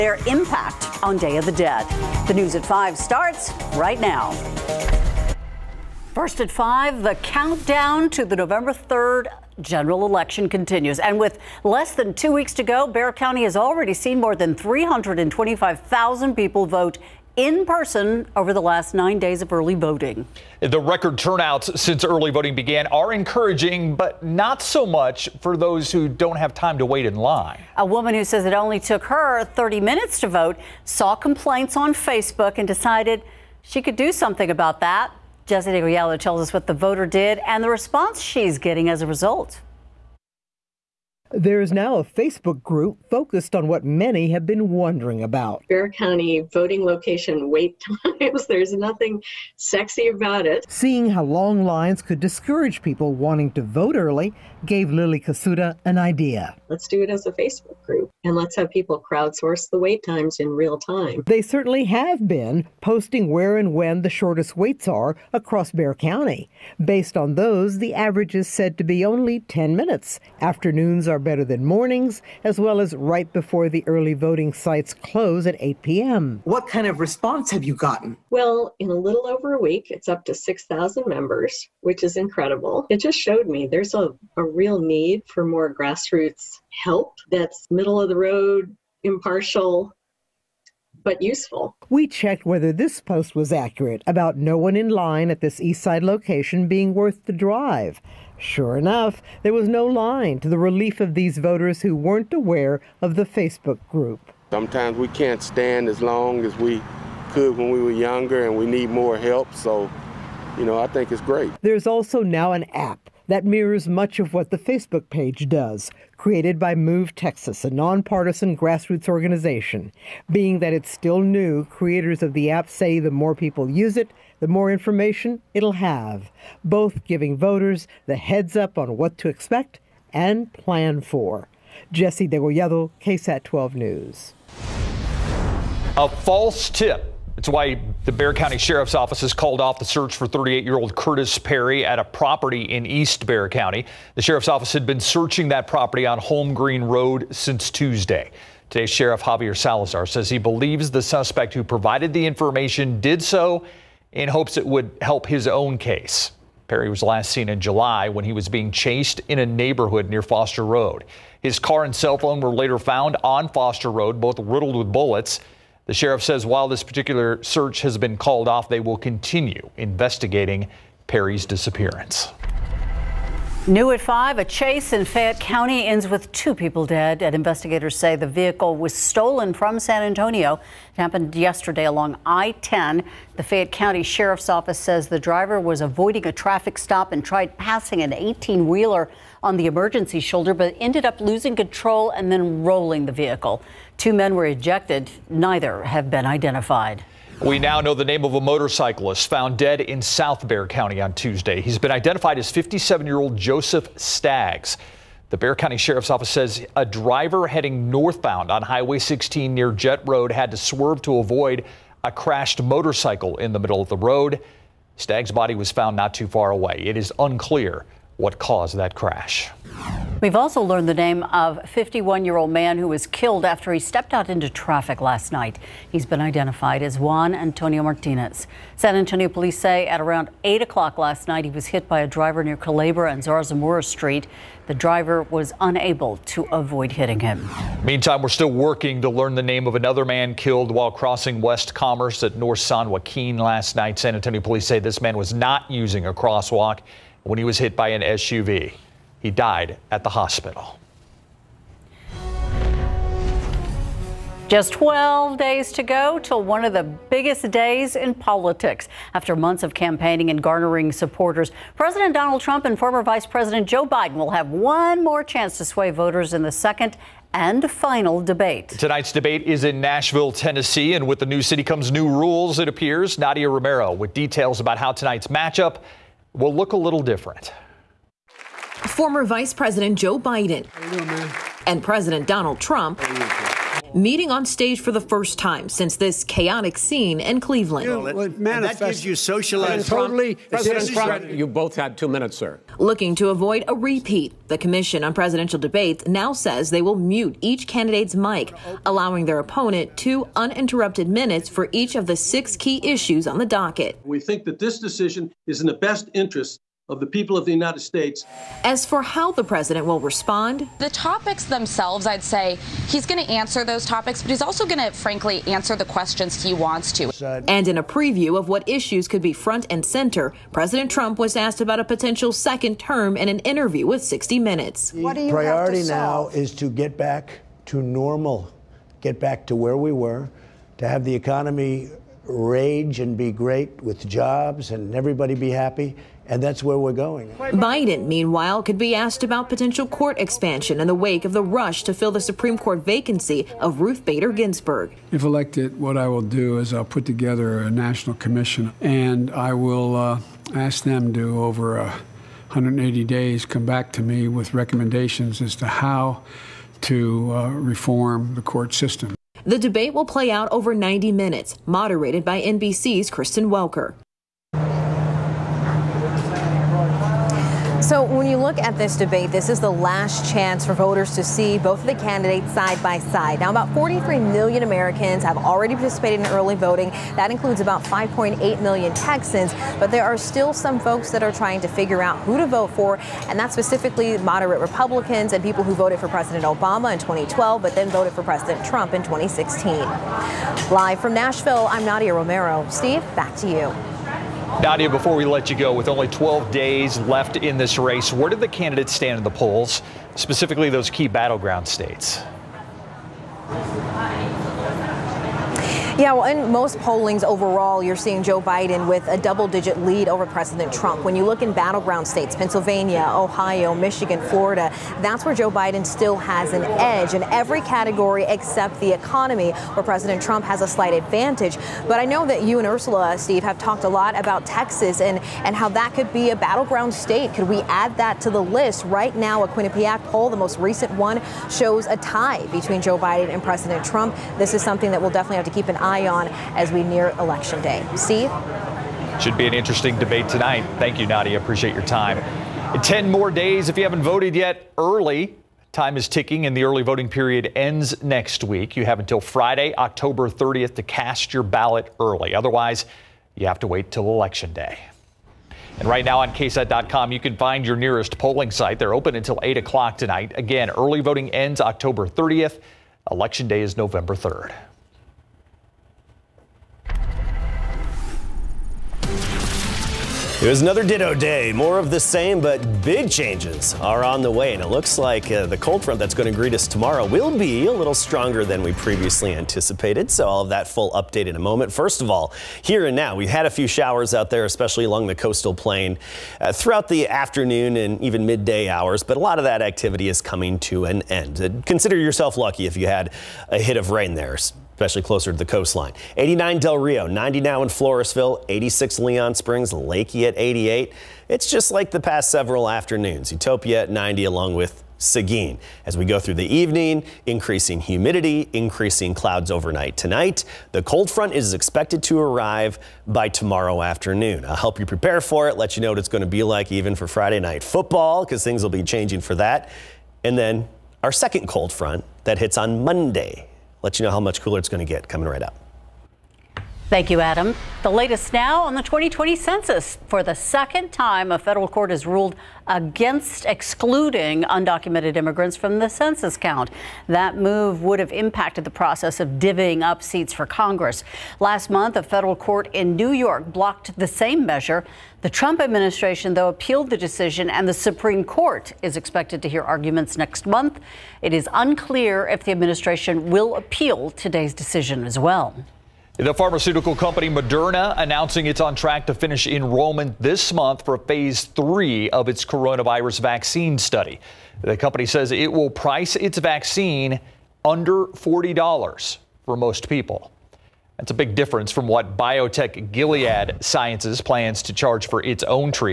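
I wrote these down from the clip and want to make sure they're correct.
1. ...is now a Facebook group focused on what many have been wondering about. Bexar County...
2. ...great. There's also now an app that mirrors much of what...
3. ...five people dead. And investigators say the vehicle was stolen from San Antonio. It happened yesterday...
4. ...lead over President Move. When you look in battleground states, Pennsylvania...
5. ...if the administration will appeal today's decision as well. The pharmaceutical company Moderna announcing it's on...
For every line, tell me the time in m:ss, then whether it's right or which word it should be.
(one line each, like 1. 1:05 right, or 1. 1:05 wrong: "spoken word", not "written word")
1. 0:41 right
2. 1:51 right
3. 2:56 wrong: "two", not "five"
4. 6:49 wrong: "Trump", not "Move"
5. 9:12 right.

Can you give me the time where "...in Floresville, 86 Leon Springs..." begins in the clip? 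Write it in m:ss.
8:17.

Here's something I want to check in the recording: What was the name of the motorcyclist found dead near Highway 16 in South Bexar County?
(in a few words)
Joseph Staggs.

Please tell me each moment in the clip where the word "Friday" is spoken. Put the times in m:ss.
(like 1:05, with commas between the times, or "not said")
7:29, 8:37.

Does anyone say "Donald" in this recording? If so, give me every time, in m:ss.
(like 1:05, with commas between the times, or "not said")
4:22, 4:42.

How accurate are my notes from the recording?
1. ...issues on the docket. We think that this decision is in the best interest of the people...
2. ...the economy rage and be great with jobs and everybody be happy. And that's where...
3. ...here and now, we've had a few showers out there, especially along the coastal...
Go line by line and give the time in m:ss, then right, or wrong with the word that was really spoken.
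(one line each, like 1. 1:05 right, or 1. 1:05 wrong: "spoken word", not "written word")
1. 5:02 right
2. 5:31 right
3. 8:02 right.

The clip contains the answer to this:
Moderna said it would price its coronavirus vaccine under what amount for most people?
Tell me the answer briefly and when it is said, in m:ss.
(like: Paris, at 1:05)
$40, at 9:28.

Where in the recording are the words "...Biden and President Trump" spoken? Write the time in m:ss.
7:12.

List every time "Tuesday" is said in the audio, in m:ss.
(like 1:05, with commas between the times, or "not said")
2:27, 3:21.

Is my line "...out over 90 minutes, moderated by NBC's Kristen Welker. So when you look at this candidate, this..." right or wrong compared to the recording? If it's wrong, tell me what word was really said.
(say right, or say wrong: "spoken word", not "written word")
wrong: "debate", not "candidate".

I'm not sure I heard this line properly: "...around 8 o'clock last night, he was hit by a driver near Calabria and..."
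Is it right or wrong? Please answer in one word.
right.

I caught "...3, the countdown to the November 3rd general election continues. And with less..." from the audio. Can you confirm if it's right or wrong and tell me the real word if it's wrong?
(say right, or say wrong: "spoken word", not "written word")
wrong: "5", not "3".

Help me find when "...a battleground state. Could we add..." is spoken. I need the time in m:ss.
7:06.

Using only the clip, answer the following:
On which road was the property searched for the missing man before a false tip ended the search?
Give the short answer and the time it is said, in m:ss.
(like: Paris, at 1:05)
Home Green Road, at 2:26.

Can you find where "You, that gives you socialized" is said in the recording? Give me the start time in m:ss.
4:47.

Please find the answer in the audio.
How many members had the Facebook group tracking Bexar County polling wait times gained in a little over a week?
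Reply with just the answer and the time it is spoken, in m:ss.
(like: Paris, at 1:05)
6,000, at 1:20.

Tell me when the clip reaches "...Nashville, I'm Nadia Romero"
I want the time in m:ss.
6:31.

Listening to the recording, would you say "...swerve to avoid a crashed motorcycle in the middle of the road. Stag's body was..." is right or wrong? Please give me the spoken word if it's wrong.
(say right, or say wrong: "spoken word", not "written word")
right.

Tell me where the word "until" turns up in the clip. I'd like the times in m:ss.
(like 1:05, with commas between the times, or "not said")
7:28, 7:39.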